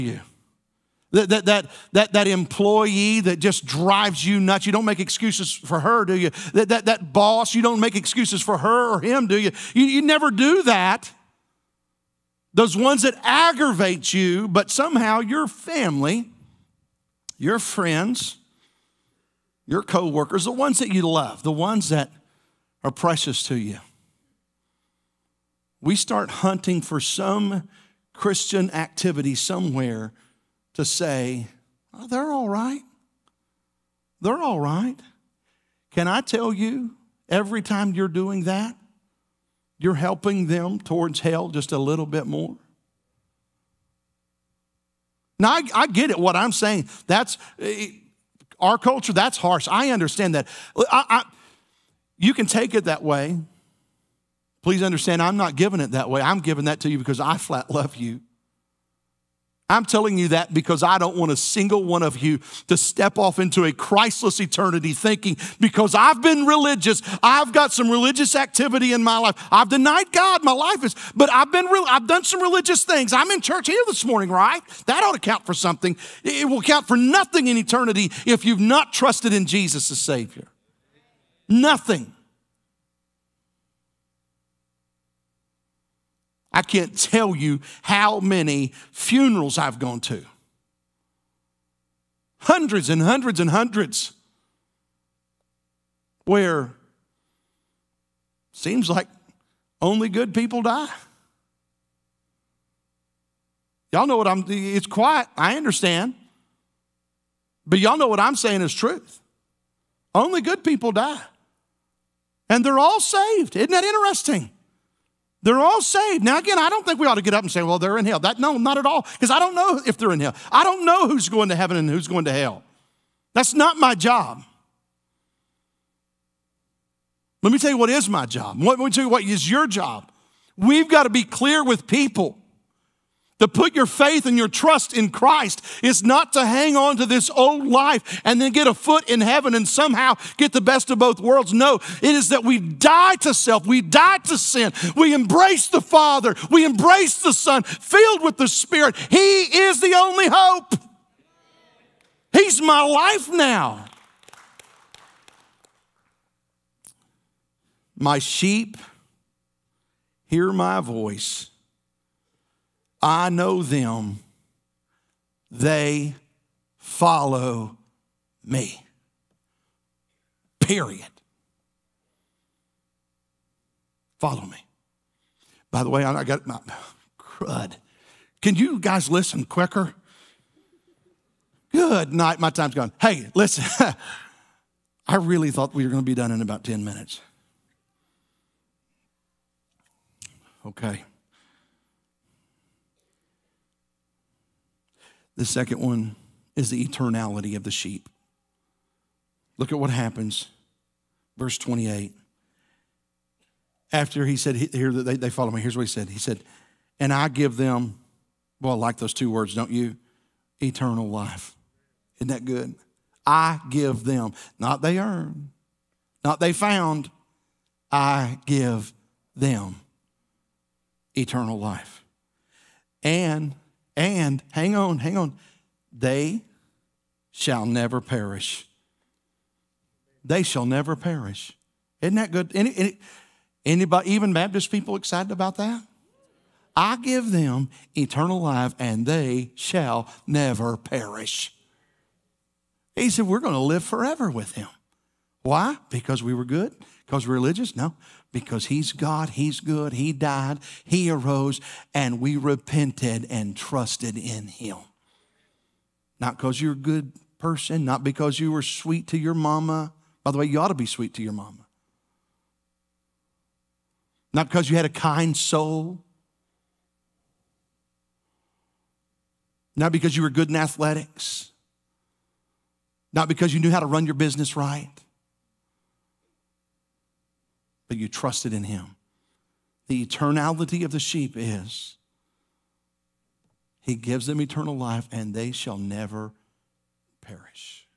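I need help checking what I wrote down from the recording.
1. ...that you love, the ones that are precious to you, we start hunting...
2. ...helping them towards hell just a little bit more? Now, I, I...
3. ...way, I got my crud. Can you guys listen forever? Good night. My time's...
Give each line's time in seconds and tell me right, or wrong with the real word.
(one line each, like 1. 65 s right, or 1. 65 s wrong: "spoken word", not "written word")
1. 20 s right
2. 39 s right
3. 175 s wrong: "quicker", not "forever".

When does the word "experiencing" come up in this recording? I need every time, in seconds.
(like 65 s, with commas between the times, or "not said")
not said.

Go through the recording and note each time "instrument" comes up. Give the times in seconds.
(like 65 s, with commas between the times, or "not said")
not said.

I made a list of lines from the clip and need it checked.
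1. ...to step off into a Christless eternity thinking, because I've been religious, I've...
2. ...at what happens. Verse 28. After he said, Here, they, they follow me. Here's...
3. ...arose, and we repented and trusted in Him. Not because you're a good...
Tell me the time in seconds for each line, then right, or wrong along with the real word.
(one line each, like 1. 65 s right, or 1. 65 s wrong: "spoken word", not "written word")
1. 62 s right
2. 199 s right
3. 251 s right.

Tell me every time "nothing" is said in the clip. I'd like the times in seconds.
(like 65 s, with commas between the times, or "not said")
76 s, 81 s.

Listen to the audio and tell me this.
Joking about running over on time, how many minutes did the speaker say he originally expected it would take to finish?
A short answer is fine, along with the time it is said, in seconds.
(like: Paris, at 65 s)
10 minutes, at 186 s.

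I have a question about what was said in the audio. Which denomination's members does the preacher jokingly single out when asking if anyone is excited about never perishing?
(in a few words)
Baptist.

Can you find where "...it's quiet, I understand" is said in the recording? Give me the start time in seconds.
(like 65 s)
104 s.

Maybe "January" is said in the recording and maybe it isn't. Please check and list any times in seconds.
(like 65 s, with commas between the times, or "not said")
not said.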